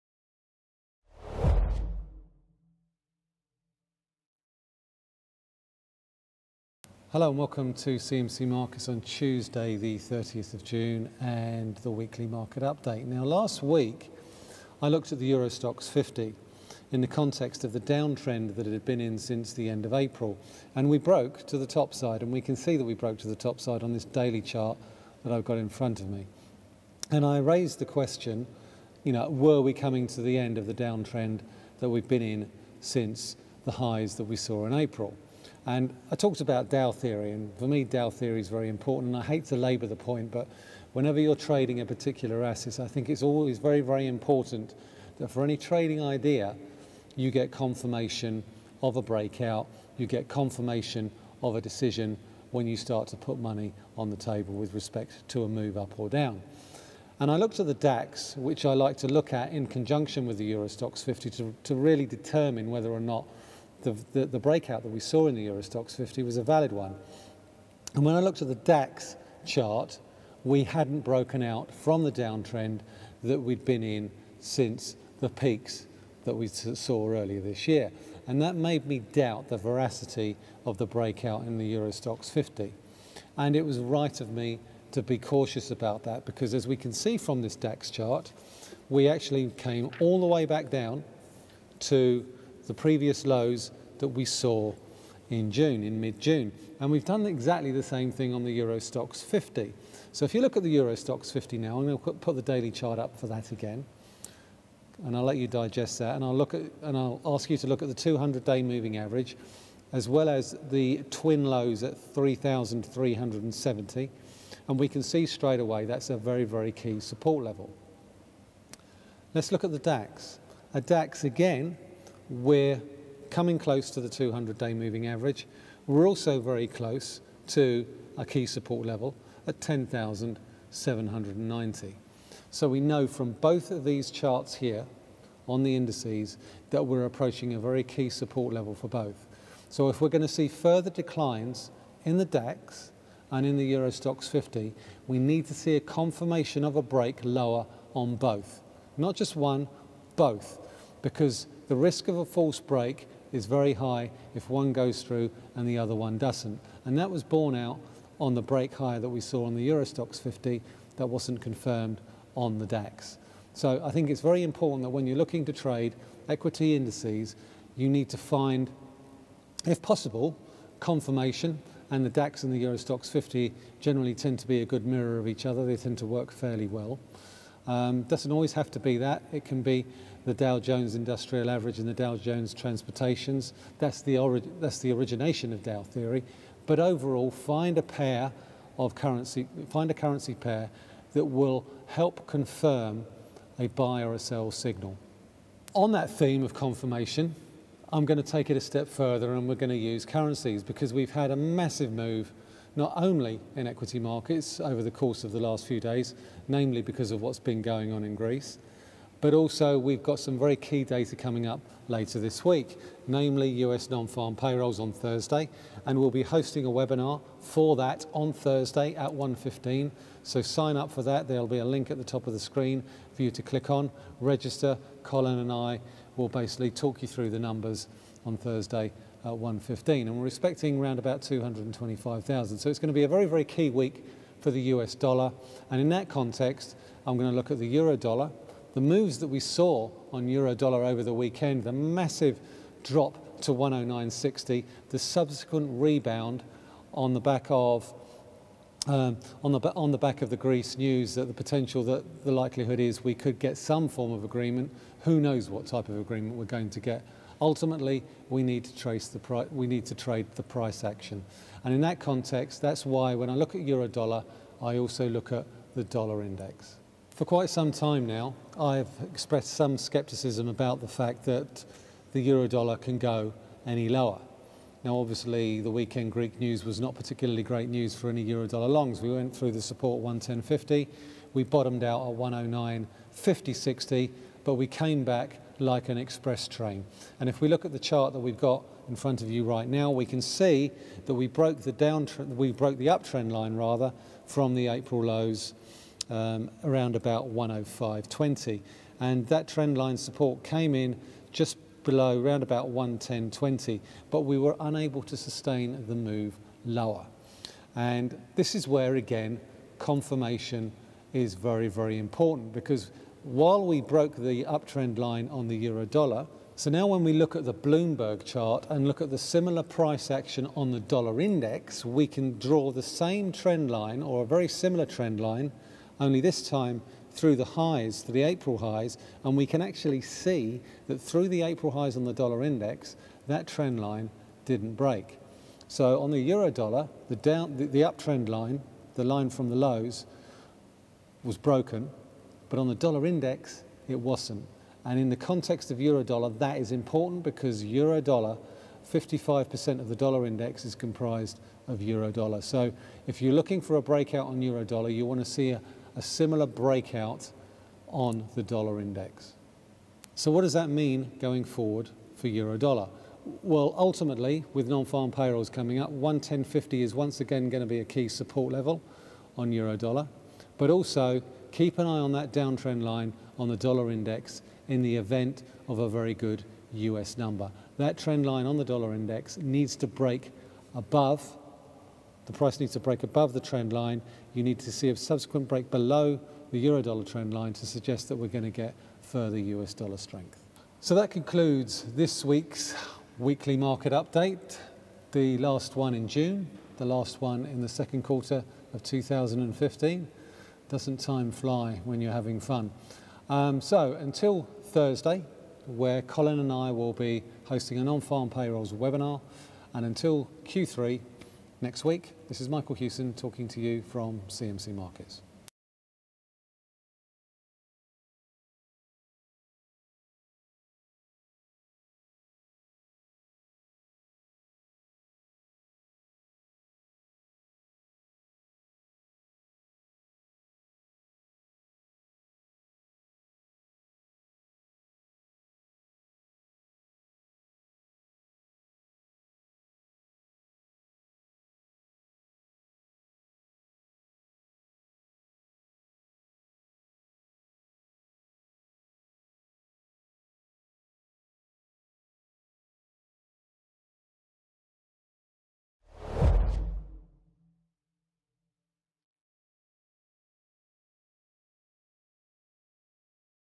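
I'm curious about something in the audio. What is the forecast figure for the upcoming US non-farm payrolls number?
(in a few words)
225,000.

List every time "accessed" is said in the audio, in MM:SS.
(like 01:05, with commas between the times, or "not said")
not said.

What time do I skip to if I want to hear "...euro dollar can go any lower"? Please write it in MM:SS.
04:32.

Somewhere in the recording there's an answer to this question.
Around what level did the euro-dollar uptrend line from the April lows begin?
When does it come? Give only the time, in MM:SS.
04:57.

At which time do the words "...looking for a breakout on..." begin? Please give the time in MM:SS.
05:53.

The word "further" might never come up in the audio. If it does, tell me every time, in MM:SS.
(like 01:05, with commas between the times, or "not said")
02:20, 03:18, 06:29.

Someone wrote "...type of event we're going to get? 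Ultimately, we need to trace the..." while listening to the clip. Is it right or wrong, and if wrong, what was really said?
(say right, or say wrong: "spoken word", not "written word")
wrong: "agreement", not "event".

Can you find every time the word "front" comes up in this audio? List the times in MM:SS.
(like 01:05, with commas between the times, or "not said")
00:25, 04:48.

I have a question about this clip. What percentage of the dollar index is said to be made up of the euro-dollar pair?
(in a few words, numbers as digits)
55%.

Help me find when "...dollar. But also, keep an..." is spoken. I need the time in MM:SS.
06:09.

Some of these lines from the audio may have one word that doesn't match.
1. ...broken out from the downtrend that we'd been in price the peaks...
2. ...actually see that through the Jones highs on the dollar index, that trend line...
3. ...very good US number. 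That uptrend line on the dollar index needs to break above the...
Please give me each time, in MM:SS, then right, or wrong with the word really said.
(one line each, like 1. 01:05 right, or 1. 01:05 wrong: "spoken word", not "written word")
1. 01:11 wrong: "since", not "price"
2. 05:29 wrong: "April", not "Jones"
3. 06:15 wrong: "trend", not "uptrend".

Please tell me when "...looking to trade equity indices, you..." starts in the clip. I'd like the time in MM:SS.
02:45.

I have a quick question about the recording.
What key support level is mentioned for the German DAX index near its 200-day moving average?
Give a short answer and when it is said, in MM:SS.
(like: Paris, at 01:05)
10,790, at 02:09.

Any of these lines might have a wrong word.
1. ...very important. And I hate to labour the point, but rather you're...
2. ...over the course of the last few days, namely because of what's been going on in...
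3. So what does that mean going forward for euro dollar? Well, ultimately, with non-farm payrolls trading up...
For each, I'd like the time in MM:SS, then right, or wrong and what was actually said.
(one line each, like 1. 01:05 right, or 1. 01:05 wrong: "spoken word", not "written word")
1. 00:38 wrong: "whenever", not "rather"
2. 03:24 right
3. 06:00 wrong: "coming", not "trading".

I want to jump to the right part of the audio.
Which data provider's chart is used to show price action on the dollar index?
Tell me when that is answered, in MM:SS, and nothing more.
05:17.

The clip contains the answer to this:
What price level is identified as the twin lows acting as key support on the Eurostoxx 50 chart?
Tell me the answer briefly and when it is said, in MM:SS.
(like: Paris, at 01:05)
3,370, at 01:52.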